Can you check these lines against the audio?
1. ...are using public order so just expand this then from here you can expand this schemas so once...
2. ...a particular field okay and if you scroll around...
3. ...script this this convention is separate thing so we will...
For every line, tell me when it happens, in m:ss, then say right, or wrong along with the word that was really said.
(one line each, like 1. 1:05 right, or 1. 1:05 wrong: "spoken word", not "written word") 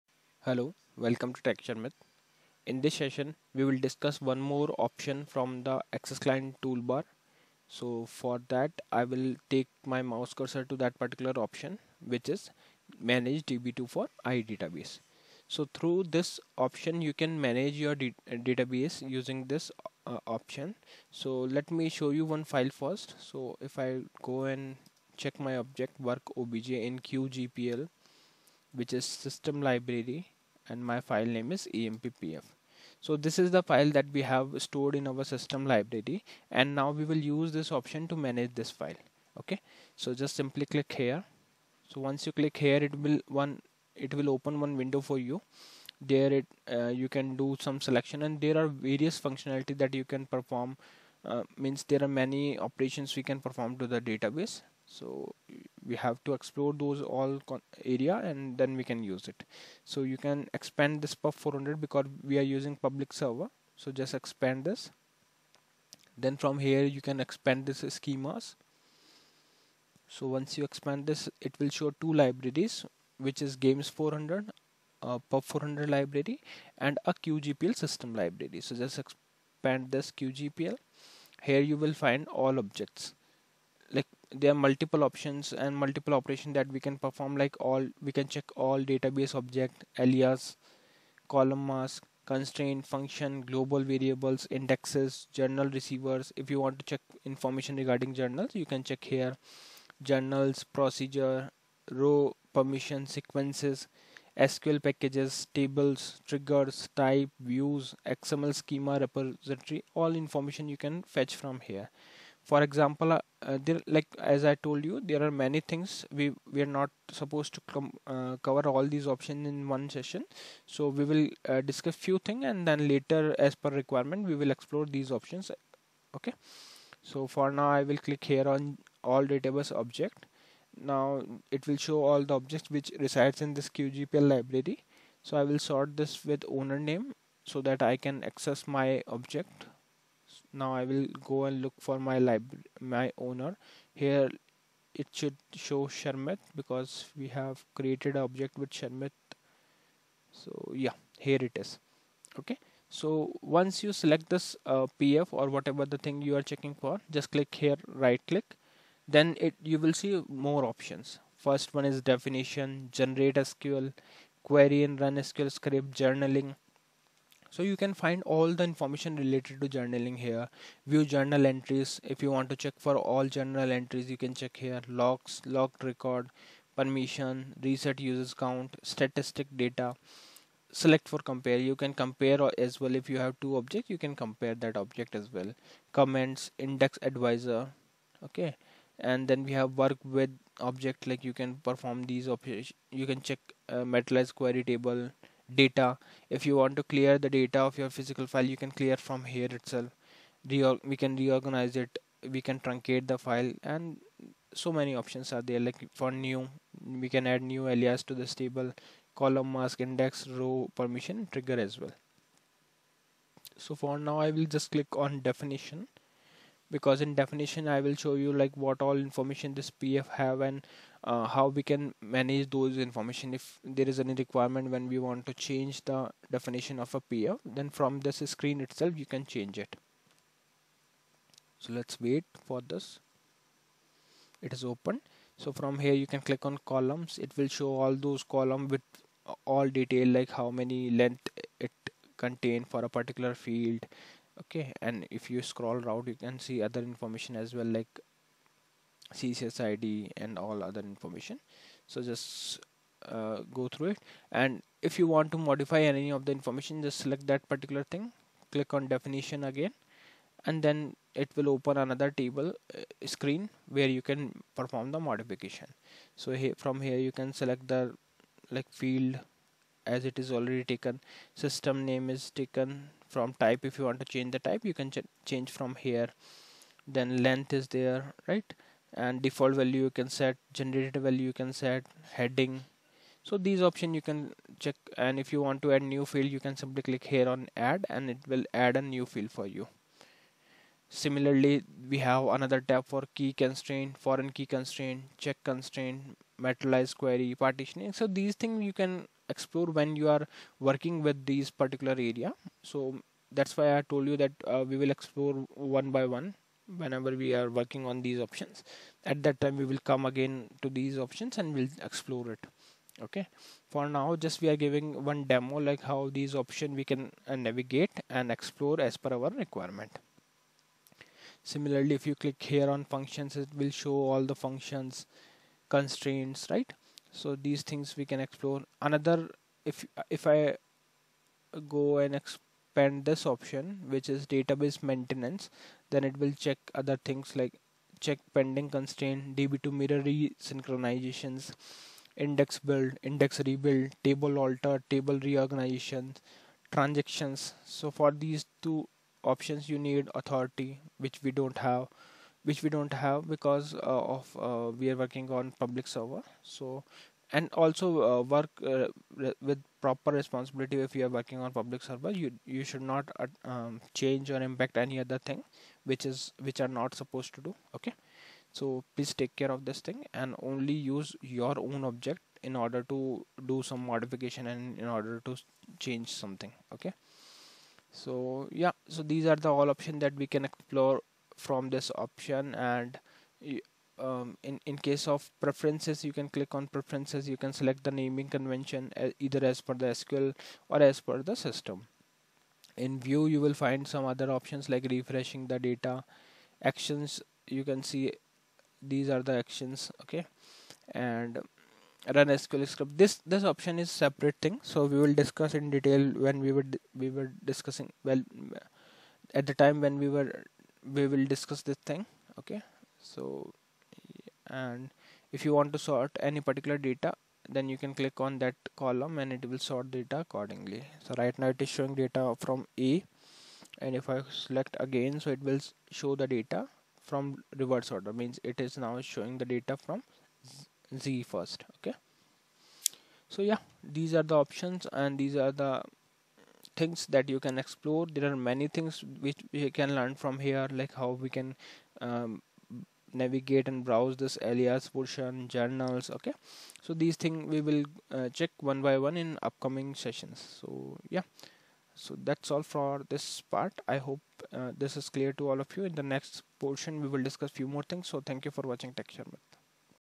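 1. 1:02 wrong: "server", not "order"
2. 4:02 right
3. 6:42 wrong: "option", not "convention".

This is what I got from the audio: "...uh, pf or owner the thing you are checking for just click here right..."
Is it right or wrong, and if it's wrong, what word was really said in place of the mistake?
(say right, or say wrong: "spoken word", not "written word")
wrong: "whatever", not "owner".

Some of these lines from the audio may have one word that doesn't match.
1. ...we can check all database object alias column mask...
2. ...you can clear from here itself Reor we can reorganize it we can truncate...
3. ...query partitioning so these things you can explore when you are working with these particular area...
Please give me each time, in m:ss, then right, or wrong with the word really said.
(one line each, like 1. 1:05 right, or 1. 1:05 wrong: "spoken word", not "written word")
1. 1:28 right
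2. 3:18 right
3. 4:57 right.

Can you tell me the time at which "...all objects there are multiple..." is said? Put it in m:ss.
1:22.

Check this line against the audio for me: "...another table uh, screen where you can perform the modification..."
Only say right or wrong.
right.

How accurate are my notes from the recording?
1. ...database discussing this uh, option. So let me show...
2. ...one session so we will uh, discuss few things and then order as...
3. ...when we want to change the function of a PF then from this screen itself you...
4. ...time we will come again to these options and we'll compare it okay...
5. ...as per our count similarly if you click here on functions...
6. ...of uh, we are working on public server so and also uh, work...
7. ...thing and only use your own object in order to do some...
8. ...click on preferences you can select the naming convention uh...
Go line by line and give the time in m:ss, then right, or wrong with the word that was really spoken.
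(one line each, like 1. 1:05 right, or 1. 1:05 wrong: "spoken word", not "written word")
1. 0:18 wrong: "using", not "discussing"
2. 1:59 wrong: "later", not "order"
3. 3:44 wrong: "definition", not "function"
4. 5:09 wrong: "explore", not "compare"
5. 5:18 wrong: "requirement", not "count"
6. 5:54 right
7. 6:09 right
8. 6:26 right.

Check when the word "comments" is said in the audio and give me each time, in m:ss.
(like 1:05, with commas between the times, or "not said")
3:05.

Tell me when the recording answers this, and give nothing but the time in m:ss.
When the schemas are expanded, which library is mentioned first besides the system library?
1:13.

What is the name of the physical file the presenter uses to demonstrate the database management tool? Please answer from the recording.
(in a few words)
emppf.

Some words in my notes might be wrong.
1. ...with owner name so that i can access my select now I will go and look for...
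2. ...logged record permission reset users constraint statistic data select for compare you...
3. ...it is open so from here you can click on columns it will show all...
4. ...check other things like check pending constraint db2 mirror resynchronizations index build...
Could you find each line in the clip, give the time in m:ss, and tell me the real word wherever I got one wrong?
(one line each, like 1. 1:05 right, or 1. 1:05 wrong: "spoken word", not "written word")
1. 2:16 wrong: "object", not "select"
2. 2:55 wrong: "count", not "constraint"
3. 3:54 right
4. 5:36 right.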